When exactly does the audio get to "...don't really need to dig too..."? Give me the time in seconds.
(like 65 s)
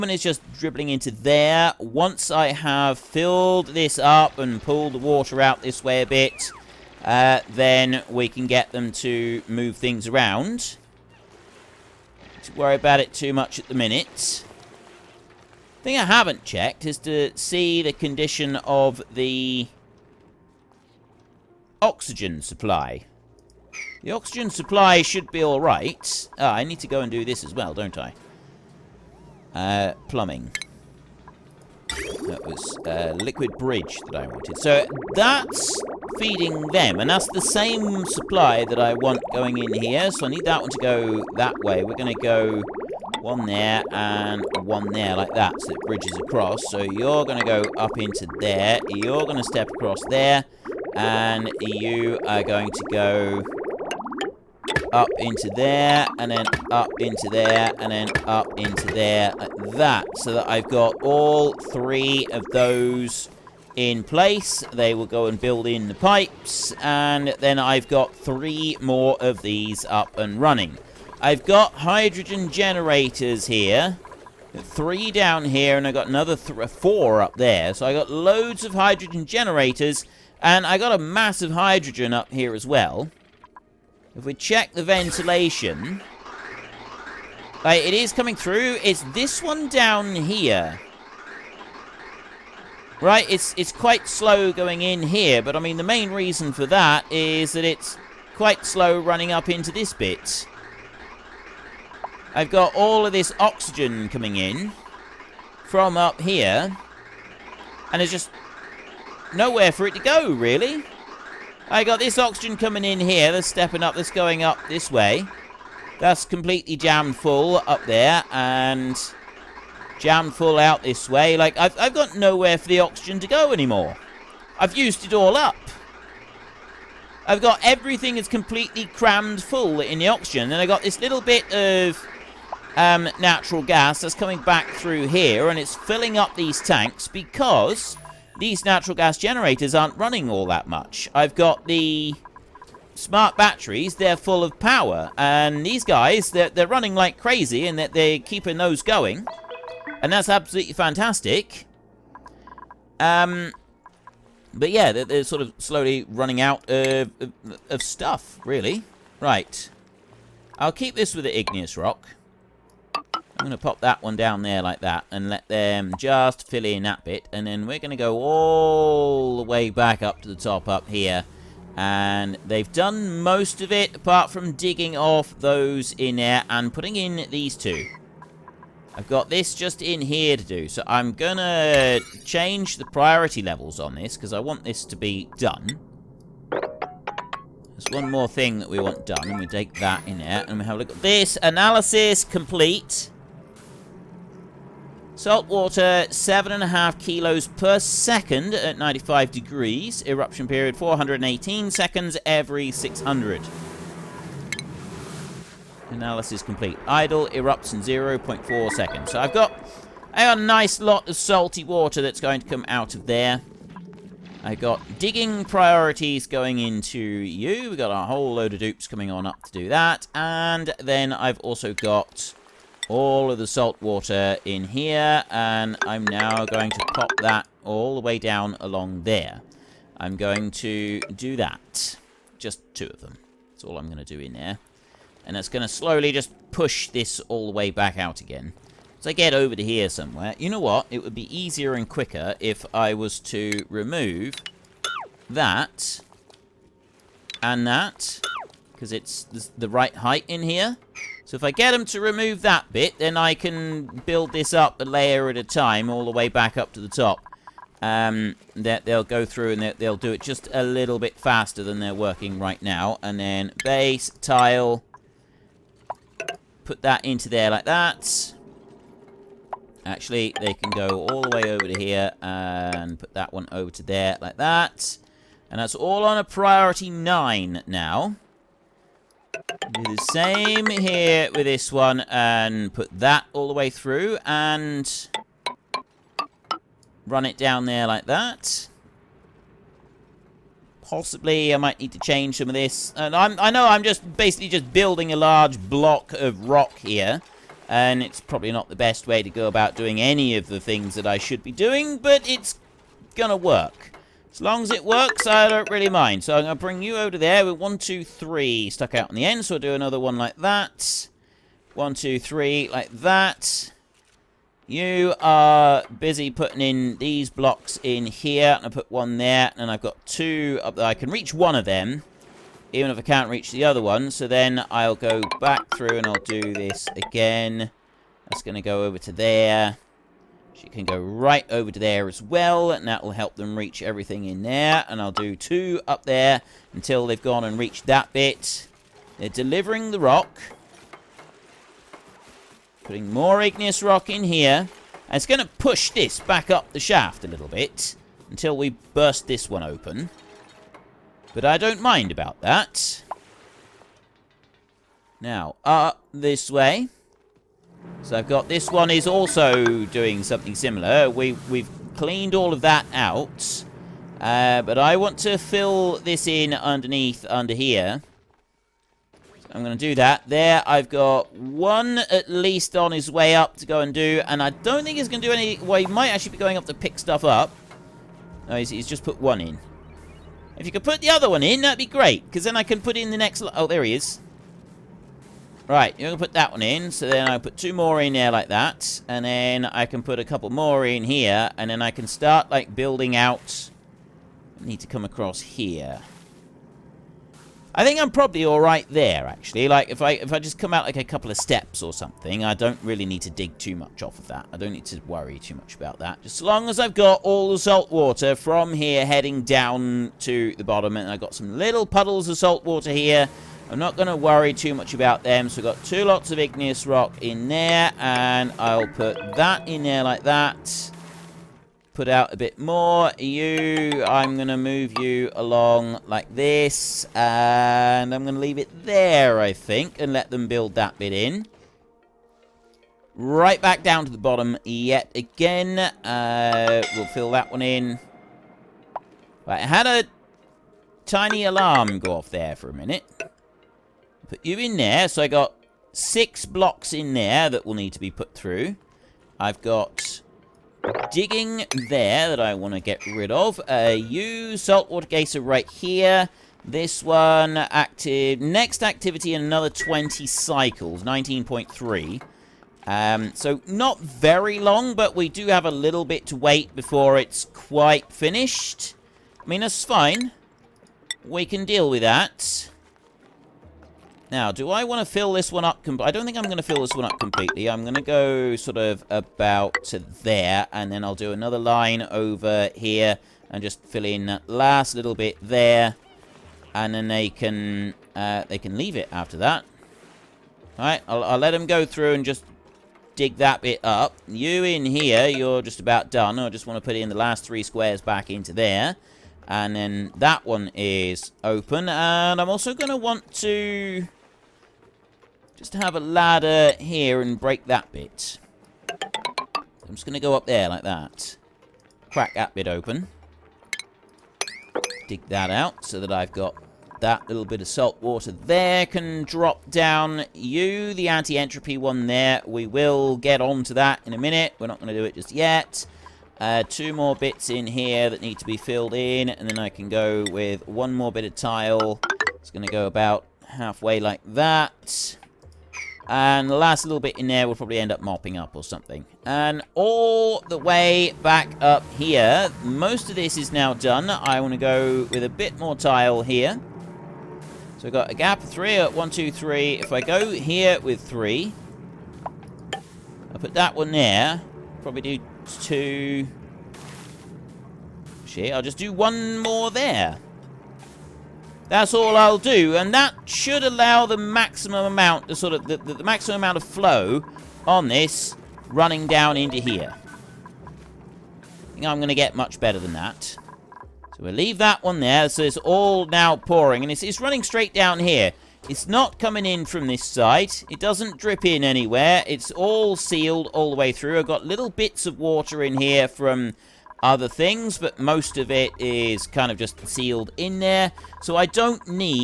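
402 s.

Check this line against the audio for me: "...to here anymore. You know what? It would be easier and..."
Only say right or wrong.
wrong.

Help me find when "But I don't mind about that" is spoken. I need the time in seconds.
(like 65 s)
351 s.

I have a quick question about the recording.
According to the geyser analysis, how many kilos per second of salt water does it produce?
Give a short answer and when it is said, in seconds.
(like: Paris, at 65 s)
7.5, at 196 s.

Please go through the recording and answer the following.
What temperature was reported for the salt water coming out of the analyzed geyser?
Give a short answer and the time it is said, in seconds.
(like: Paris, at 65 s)
95 degrees, at 198 s.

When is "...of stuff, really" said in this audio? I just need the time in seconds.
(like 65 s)
157 s.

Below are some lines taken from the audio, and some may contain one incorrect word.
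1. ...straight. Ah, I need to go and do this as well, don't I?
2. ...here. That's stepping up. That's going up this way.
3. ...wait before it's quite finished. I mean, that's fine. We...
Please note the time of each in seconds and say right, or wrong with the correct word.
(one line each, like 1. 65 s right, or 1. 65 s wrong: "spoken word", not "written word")
1. 25 s wrong: "alright", not "straight"
2. 113 s right
3. 466 s right.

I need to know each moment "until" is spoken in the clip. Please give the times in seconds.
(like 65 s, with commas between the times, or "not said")
336 s, 348 s.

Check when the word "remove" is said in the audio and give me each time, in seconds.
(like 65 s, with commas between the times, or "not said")
243 s, 251 s.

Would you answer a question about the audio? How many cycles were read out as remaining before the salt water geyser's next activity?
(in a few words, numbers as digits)
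19.3.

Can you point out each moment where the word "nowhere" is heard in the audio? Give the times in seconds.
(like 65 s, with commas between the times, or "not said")
109 s, 122 s.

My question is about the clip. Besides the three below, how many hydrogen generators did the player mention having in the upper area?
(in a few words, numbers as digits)
4.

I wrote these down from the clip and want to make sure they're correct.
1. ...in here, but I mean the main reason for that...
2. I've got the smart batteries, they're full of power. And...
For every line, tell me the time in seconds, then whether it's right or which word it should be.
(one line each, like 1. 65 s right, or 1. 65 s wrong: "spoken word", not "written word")
1. 94 s right
2. 141 s right.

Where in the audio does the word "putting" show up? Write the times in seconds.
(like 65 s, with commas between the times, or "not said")
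176 s, 316 s, 342 s.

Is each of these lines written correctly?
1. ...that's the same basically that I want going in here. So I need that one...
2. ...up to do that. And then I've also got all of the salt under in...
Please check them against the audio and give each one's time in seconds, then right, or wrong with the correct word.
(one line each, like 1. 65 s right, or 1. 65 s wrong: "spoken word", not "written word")
1. 37 s wrong: "supply", not "basically"
2. 219 s wrong: "water", not "under".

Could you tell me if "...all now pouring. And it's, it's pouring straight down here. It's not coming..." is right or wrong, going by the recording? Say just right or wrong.
wrong.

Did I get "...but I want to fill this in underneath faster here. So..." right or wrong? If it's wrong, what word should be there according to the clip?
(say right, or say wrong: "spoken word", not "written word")
wrong: "under", not "faster".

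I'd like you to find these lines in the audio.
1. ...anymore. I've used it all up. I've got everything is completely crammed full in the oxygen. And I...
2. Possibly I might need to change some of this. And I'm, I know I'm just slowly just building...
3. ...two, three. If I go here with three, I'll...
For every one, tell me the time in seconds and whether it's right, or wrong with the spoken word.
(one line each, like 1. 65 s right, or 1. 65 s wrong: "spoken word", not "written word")
1. 123 s right
2. 290 s wrong: "basically", not "slowly"
3. 549 s right.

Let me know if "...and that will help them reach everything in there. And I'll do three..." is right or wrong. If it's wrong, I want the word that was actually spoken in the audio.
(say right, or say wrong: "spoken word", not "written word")
wrong: "two", not "three".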